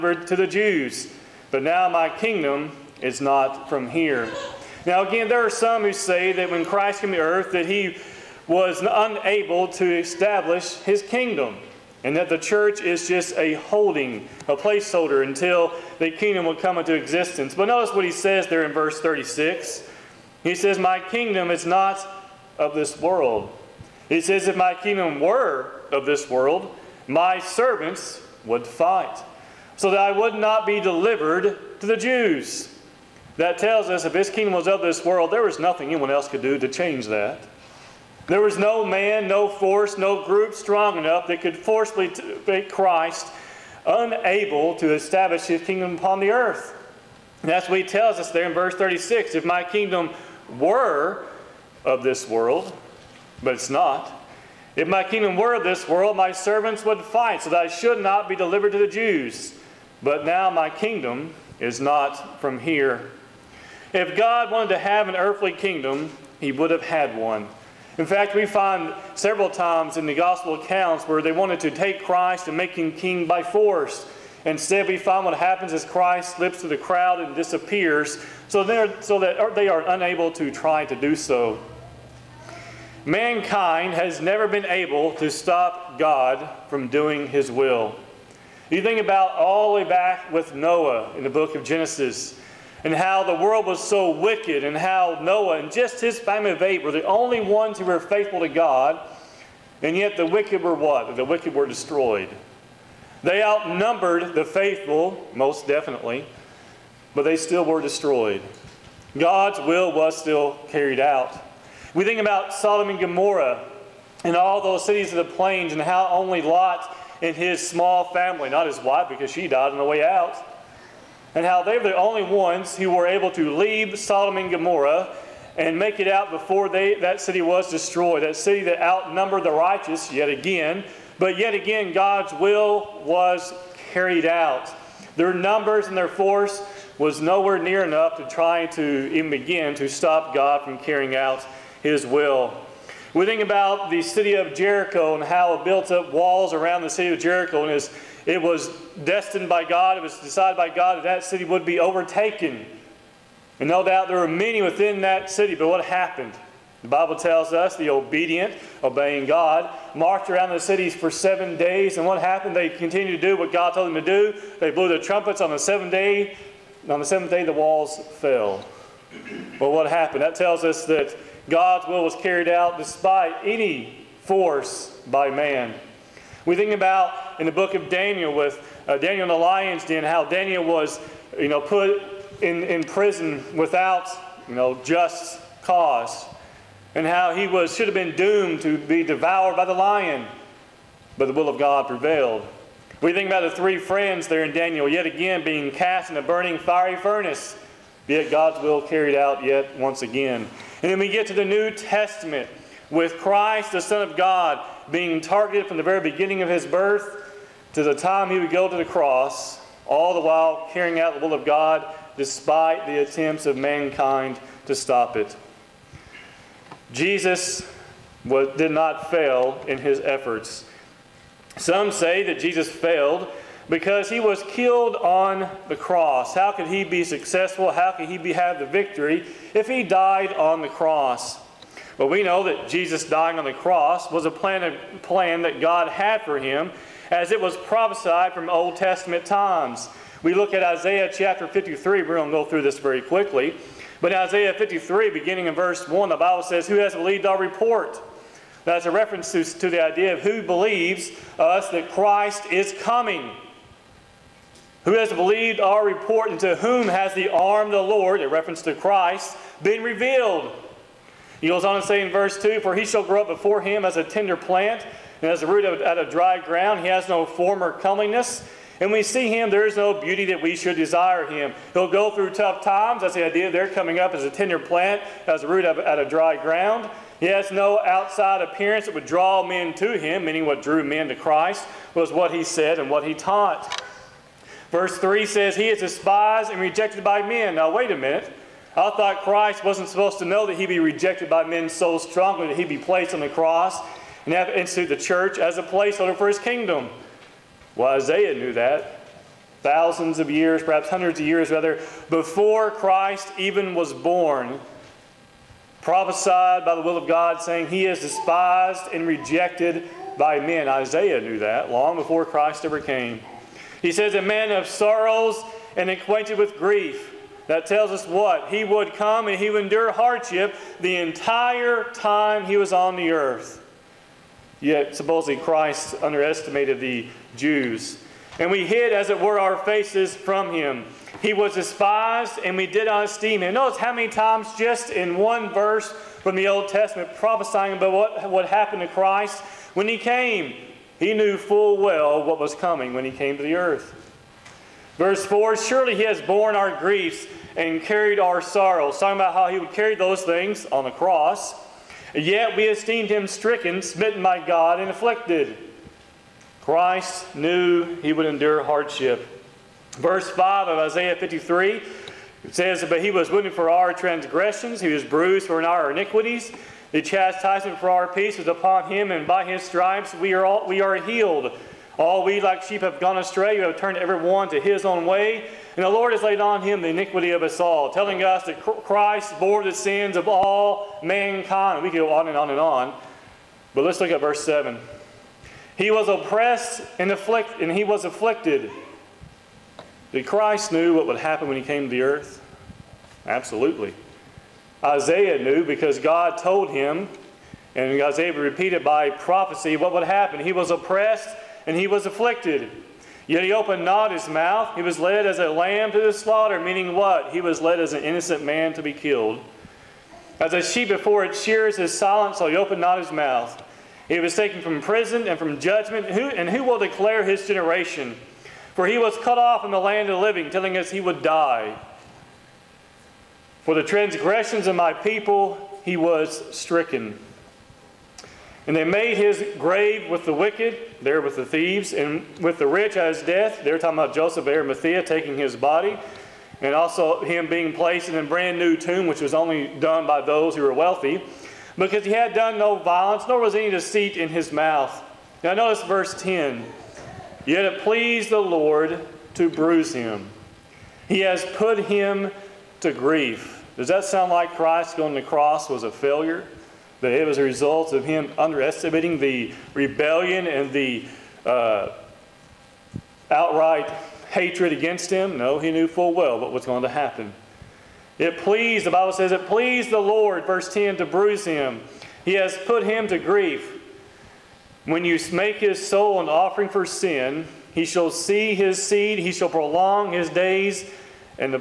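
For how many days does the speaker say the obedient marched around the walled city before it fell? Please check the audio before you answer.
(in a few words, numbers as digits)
7.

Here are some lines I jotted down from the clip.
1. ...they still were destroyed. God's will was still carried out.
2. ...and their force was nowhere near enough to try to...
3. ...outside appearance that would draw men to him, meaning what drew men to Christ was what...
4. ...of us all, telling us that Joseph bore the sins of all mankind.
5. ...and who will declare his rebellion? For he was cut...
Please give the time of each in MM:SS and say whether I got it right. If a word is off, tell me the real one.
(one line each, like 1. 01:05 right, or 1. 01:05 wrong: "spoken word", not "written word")
1. 01:47 right
2. 02:15 right
3. 04:37 right
4. 06:17 wrong: "Christ", not "Joseph"
5. 06:56 wrong: "generation", not "rebellion".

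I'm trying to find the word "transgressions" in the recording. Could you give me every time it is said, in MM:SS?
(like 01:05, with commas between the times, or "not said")
06:03, 07:03.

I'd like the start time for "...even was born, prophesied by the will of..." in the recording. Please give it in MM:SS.
05:03.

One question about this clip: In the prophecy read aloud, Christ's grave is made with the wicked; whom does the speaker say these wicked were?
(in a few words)
the thieves.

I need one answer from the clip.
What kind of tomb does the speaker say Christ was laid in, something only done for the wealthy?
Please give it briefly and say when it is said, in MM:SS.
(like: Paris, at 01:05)
a brand new tomb, at 07:18.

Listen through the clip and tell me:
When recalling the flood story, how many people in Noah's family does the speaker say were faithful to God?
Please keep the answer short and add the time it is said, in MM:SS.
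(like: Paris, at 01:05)
8, at 01:36.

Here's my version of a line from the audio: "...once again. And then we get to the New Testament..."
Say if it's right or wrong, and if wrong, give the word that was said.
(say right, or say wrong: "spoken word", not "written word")
right.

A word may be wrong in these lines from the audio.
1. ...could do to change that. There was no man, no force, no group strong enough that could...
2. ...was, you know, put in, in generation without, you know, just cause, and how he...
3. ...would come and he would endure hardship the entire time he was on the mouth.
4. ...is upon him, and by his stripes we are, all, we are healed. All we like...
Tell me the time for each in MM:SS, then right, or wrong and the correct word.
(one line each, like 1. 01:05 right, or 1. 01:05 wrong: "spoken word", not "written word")
1. 00:36 right
2. 03:00 wrong: "prison", not "generation"
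3. 05:18 wrong: "earth", not "mouth"
4. 06:08 right.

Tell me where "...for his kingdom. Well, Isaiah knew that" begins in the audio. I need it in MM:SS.
04:56.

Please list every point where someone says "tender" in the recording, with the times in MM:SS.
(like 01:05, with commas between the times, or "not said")
04:24, 04:34.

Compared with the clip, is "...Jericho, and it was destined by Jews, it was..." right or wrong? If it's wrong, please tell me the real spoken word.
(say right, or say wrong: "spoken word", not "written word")
wrong: "God", not "Jews".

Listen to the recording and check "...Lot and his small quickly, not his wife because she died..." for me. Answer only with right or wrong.
wrong.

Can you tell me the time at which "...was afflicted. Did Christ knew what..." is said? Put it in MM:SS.
06:27.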